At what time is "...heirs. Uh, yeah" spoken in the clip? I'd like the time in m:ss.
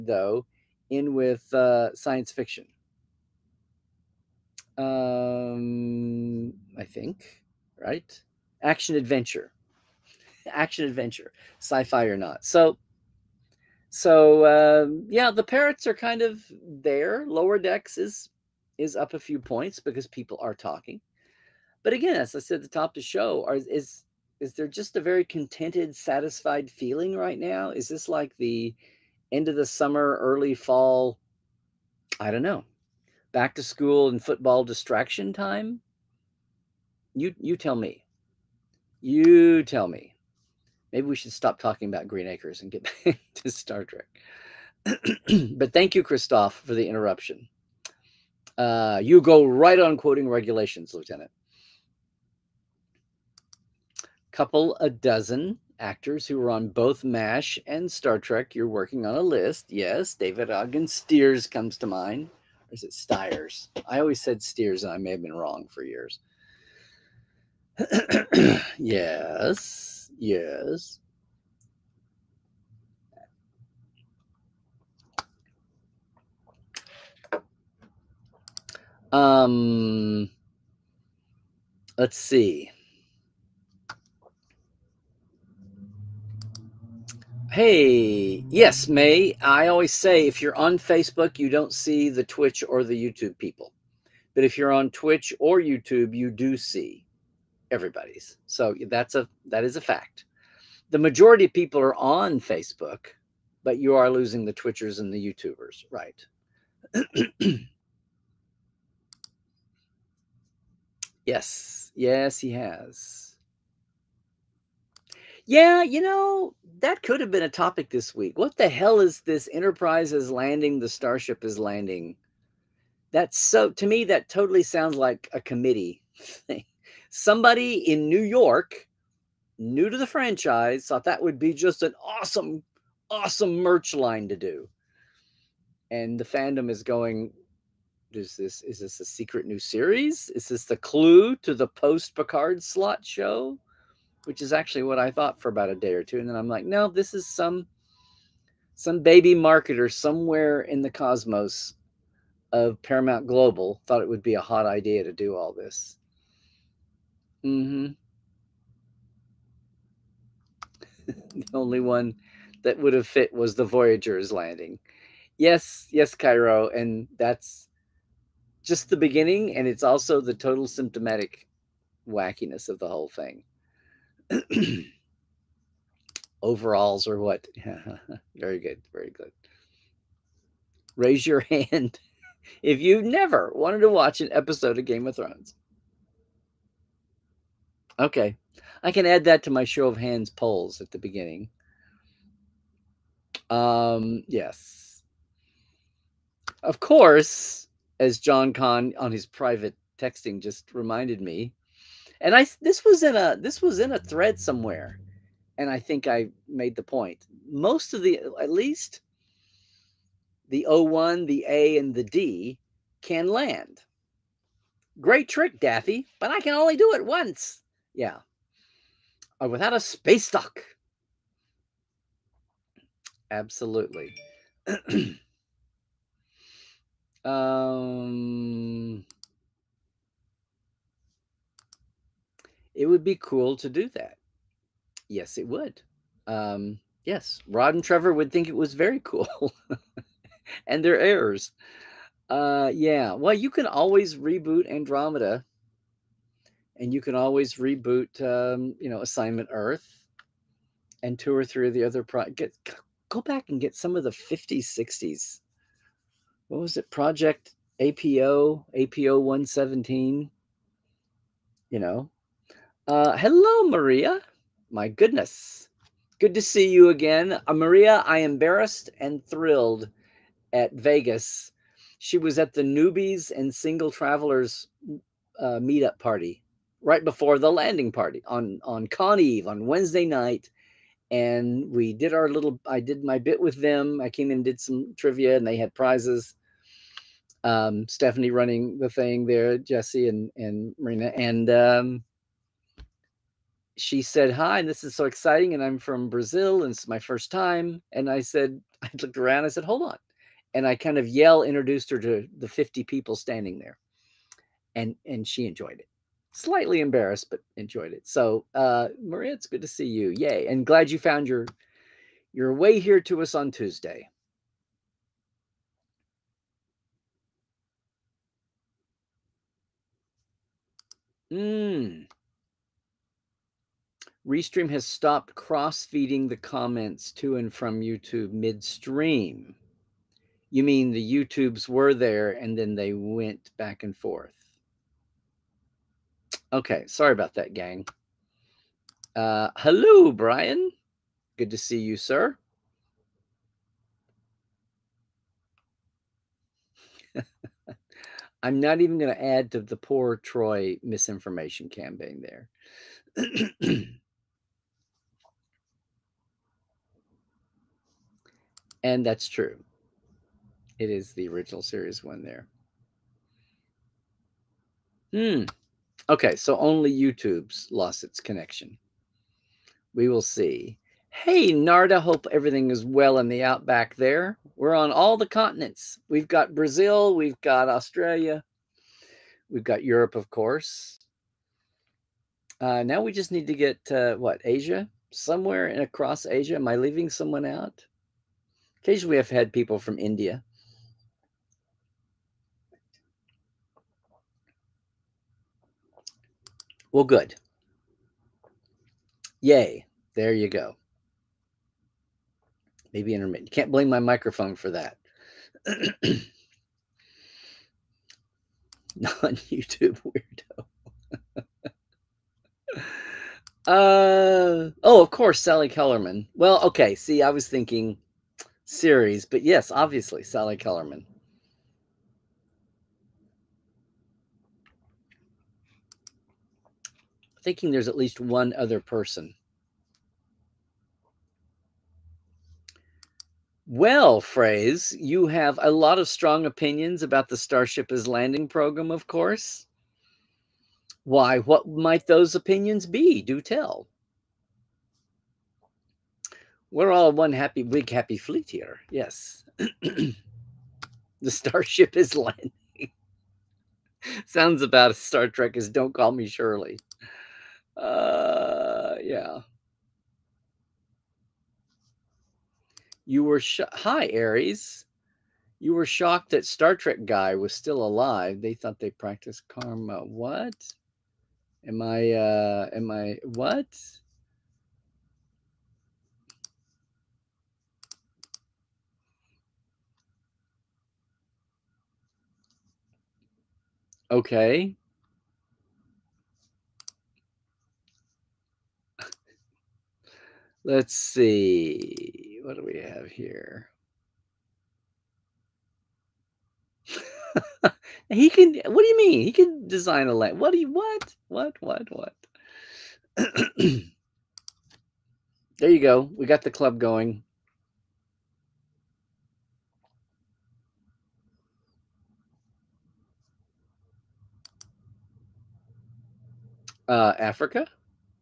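4:00.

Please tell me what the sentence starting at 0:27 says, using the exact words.
Is this like the end of the summer, early fall?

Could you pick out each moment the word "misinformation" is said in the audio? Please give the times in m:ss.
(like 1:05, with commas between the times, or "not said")
5:50.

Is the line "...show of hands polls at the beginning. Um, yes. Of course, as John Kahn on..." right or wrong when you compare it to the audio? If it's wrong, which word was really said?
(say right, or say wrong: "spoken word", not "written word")
right.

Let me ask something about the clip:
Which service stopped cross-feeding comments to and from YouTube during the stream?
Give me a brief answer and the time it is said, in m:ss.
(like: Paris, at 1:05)
Restream, at 5:24.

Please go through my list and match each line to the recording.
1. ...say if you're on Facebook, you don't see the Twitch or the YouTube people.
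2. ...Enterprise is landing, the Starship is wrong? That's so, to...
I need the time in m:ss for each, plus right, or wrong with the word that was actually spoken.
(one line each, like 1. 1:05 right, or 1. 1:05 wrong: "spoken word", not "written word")
1. 1:29 right
2. 1:59 wrong: "landing", not "wrong".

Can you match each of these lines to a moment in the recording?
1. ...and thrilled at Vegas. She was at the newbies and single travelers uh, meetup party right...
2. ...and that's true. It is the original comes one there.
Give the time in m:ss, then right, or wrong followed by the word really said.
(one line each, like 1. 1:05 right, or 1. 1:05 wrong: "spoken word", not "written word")
1. 4:28 right
2. 5:58 wrong: "series", not "comes".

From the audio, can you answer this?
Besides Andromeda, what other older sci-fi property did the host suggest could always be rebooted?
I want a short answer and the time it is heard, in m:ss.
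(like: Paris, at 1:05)
Assignment Earth, at 4:09.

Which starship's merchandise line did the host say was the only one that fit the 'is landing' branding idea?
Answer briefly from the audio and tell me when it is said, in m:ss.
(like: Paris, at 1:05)
Voyager, at 2:43.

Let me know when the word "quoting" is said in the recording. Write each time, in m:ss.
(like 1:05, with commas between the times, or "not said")
0:49.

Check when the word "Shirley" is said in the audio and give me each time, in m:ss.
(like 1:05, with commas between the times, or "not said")
7:36.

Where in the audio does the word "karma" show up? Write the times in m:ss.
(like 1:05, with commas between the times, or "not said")
7:49.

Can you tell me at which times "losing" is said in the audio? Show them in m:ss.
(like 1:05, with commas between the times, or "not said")
1:44.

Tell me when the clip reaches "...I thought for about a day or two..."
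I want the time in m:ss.
2:24.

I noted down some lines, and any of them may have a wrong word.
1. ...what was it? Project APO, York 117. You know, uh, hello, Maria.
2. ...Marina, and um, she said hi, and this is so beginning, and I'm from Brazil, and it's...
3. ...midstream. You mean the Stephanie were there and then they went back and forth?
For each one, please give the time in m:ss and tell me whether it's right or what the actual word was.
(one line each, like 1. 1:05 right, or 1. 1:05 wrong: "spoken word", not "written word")
1. 4:16 wrong: "APO", not "York"
2. 4:50 wrong: "exciting", not "beginning"
3. 5:28 wrong: "YouTubes", not "Stephanie".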